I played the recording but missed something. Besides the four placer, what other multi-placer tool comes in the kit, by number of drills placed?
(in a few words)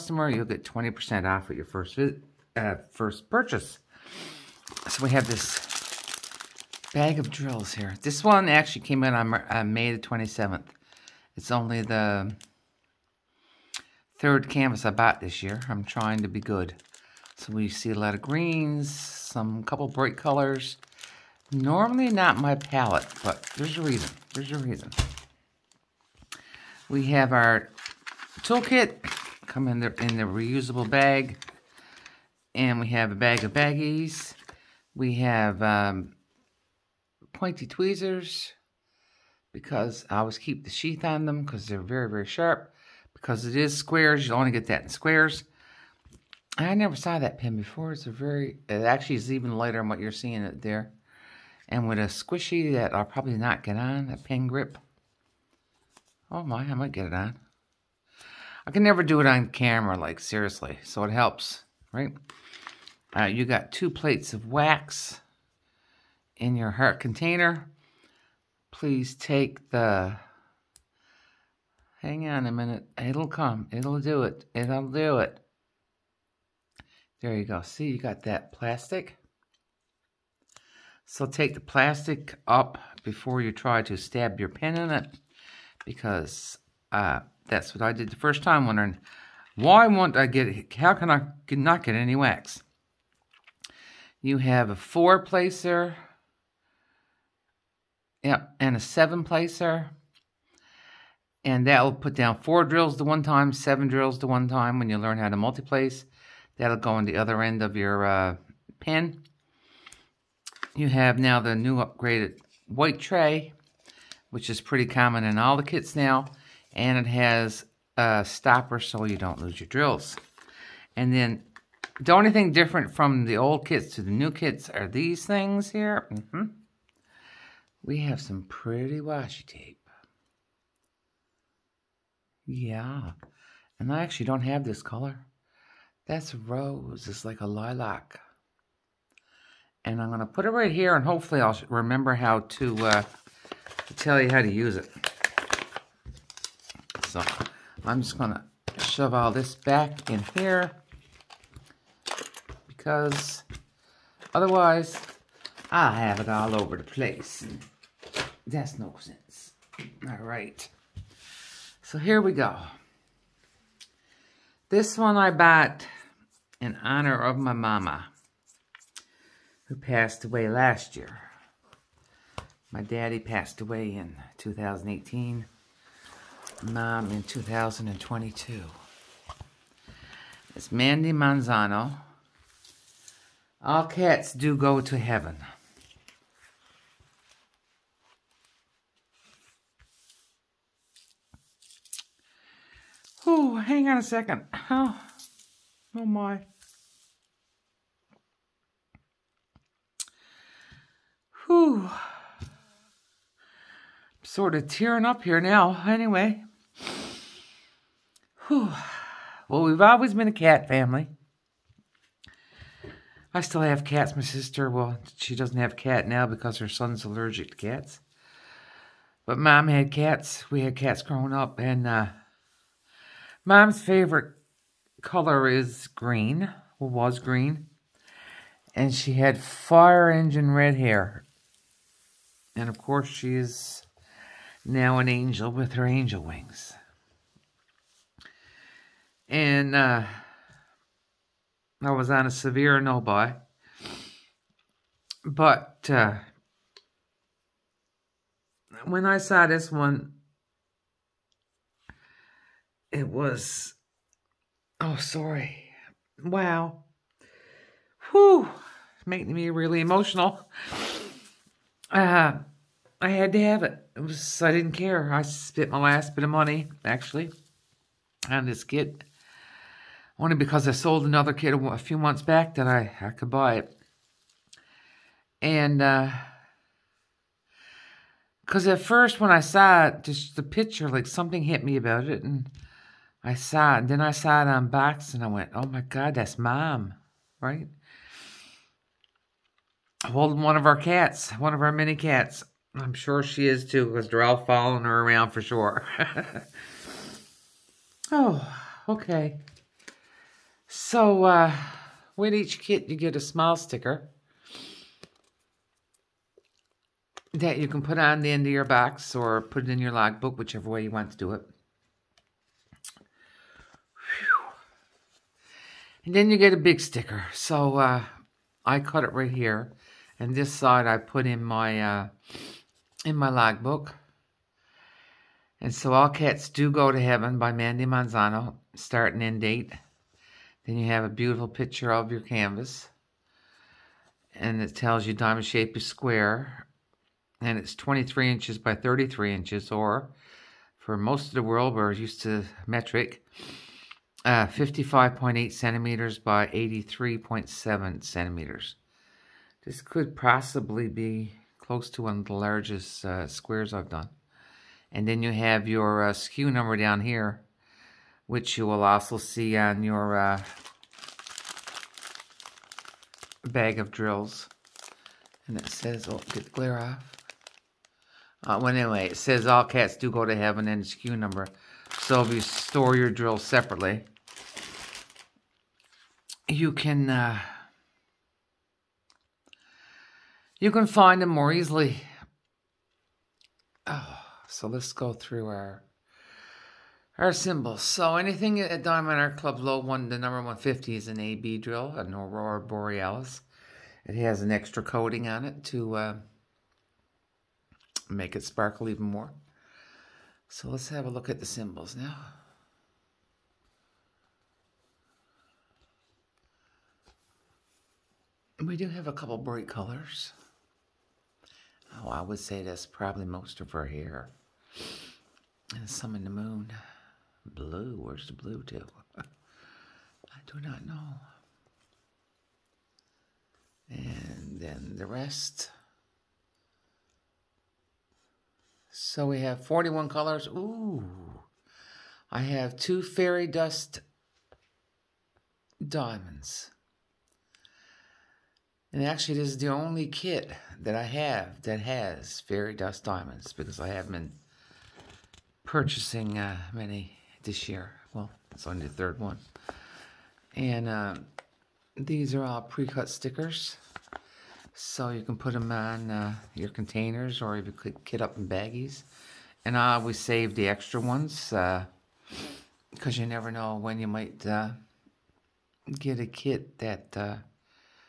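seven placer.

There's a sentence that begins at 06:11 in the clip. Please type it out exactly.
So if you store your drills separately, you can uh, you can find them more easily.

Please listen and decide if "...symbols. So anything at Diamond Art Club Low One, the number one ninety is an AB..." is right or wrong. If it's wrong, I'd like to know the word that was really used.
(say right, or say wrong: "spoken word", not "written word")
wrong: "fifty", not "ninety".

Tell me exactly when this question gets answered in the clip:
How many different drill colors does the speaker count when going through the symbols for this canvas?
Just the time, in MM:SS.
07:09.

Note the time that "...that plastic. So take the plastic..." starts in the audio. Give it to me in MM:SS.
01:18.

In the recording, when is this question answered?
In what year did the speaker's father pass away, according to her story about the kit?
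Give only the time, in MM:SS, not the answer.
02:54.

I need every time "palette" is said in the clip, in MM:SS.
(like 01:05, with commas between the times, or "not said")
00:22.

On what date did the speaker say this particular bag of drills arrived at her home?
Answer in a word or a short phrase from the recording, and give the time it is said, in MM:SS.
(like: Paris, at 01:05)
May 27, at 00:09.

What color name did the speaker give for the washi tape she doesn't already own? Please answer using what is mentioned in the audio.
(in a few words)
rose.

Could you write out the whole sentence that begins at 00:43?
Because it is squares, you'll only get that in squares.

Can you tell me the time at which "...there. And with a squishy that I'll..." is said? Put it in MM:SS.
00:50.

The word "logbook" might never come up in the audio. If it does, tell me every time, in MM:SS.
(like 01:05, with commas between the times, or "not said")
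05:09, 05:23.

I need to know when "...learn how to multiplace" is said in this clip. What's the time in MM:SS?
01:44.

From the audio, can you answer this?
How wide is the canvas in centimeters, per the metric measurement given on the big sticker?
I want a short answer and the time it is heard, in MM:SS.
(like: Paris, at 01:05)
55.8 centimeters, at 05:44.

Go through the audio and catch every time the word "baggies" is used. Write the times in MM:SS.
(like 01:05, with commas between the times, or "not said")
00:33, 07:38.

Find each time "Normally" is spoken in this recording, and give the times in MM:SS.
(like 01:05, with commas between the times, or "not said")
00:21.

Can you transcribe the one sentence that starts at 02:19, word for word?
And I'm gonna put it right here and hopefully I'll remember how to, uh, tell you how to use it.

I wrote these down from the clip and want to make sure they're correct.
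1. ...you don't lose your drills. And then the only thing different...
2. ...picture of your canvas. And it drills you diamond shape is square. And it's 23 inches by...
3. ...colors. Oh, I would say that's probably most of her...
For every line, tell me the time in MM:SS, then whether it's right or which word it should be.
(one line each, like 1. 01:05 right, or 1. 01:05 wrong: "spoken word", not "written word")
1. 01:59 right
2. 05:31 wrong: "tells", not "drills"
3. 06:49 right.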